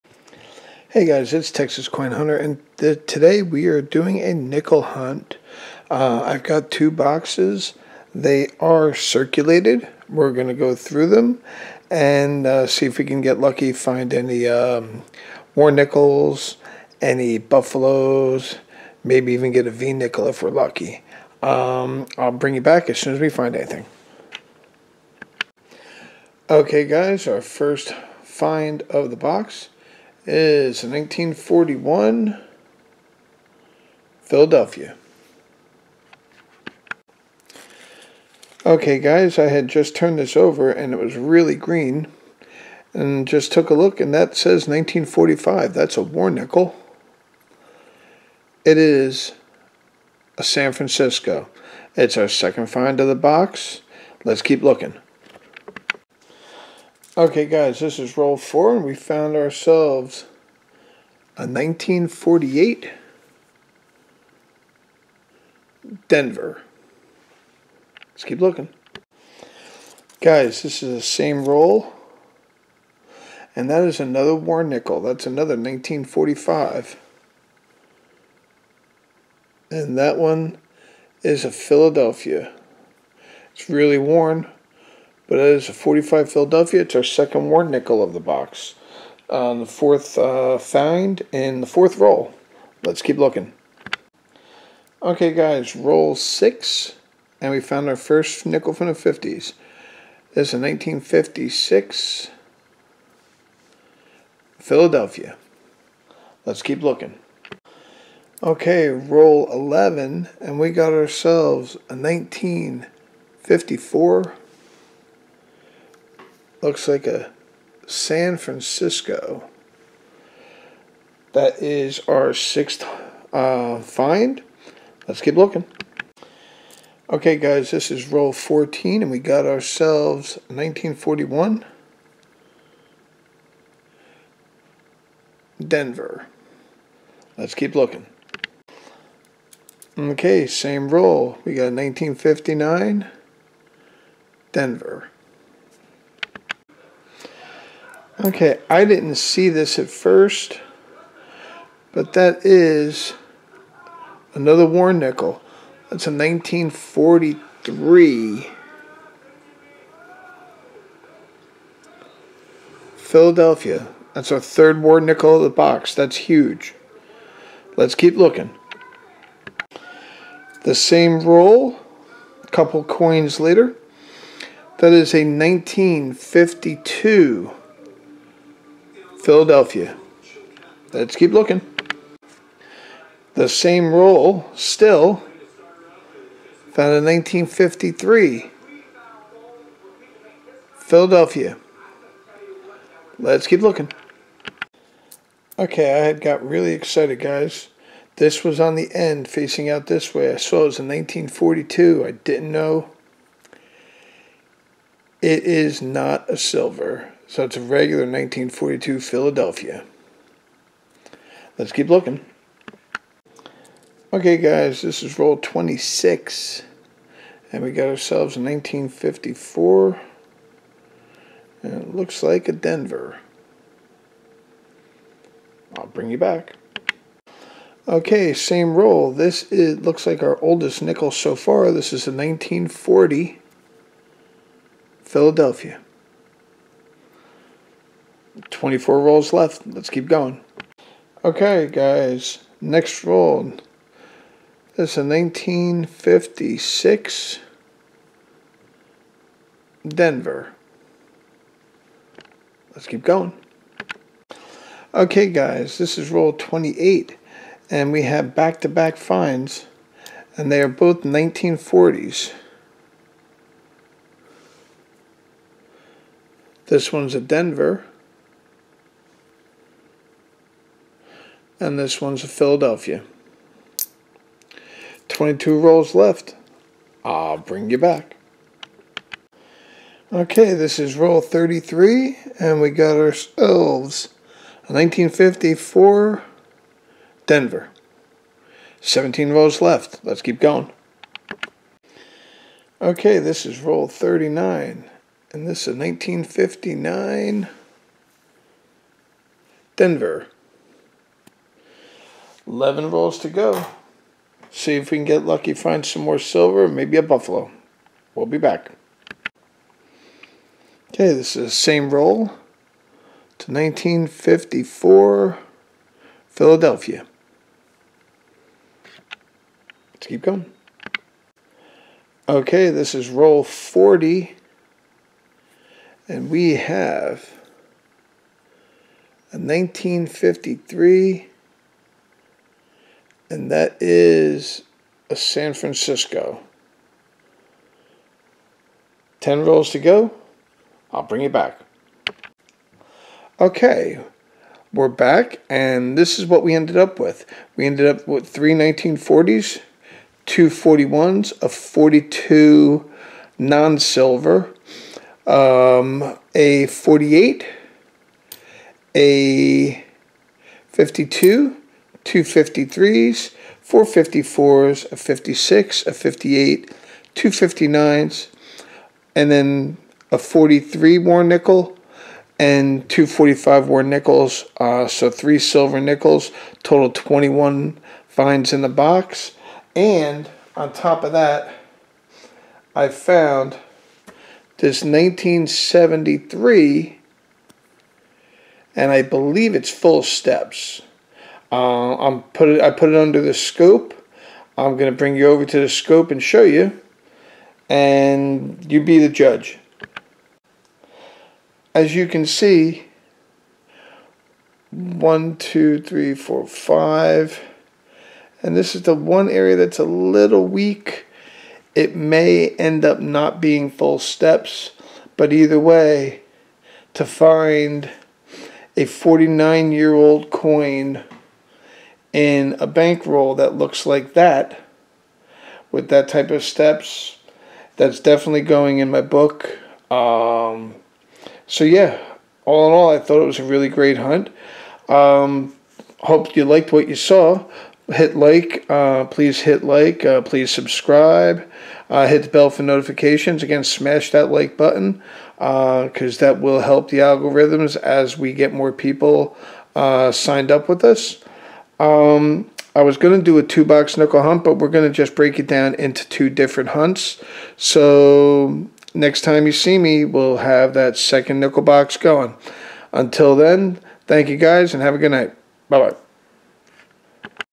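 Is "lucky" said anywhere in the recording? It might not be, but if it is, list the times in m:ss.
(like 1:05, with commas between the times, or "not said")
0:13, 0:20, 5:05.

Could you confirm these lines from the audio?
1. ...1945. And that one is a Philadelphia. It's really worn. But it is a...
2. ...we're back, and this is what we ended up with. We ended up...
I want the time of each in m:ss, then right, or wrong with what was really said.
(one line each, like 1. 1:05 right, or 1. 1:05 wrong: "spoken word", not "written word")
1. 1:15 right
2. 5:44 right.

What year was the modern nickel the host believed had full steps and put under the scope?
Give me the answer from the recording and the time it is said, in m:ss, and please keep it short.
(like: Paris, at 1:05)
1973, at 6:24.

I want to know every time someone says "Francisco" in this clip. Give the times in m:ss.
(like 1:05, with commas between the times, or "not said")
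0:50, 1:58, 5:35.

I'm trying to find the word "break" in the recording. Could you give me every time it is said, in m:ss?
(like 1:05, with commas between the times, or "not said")
7:35.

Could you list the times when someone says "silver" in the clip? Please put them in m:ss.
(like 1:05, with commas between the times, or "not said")
3:26, 5:06, 5:53, 6:15.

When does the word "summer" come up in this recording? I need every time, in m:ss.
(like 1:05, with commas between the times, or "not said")
not said.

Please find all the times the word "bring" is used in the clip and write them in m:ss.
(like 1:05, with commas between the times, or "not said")
0:22, 3:45, 4:37, 5:41, 6:34.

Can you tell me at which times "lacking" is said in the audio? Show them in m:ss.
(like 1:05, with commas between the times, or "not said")
not said.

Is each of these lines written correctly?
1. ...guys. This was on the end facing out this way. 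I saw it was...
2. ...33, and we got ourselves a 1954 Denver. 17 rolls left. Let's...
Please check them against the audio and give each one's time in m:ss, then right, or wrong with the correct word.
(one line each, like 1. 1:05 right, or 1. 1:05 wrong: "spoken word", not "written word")
1. 3:17 right
2. 4:41 right.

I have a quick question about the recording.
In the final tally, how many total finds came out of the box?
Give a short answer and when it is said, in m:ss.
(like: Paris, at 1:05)
21, at 6:16.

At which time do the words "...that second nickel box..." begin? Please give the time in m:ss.
7:40.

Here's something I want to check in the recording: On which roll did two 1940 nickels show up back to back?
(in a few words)
28.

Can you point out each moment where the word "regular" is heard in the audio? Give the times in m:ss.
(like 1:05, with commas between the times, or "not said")
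3:27.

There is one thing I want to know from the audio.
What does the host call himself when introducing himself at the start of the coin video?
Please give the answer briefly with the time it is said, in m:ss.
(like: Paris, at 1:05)
Texas Coin Hunter, at 0:01.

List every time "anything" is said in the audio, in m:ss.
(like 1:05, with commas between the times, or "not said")
0:23.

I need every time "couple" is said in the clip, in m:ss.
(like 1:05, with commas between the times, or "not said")
2:52.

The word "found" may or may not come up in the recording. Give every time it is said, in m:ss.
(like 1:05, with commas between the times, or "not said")
0:58, 1:37, 3:06, 6:22.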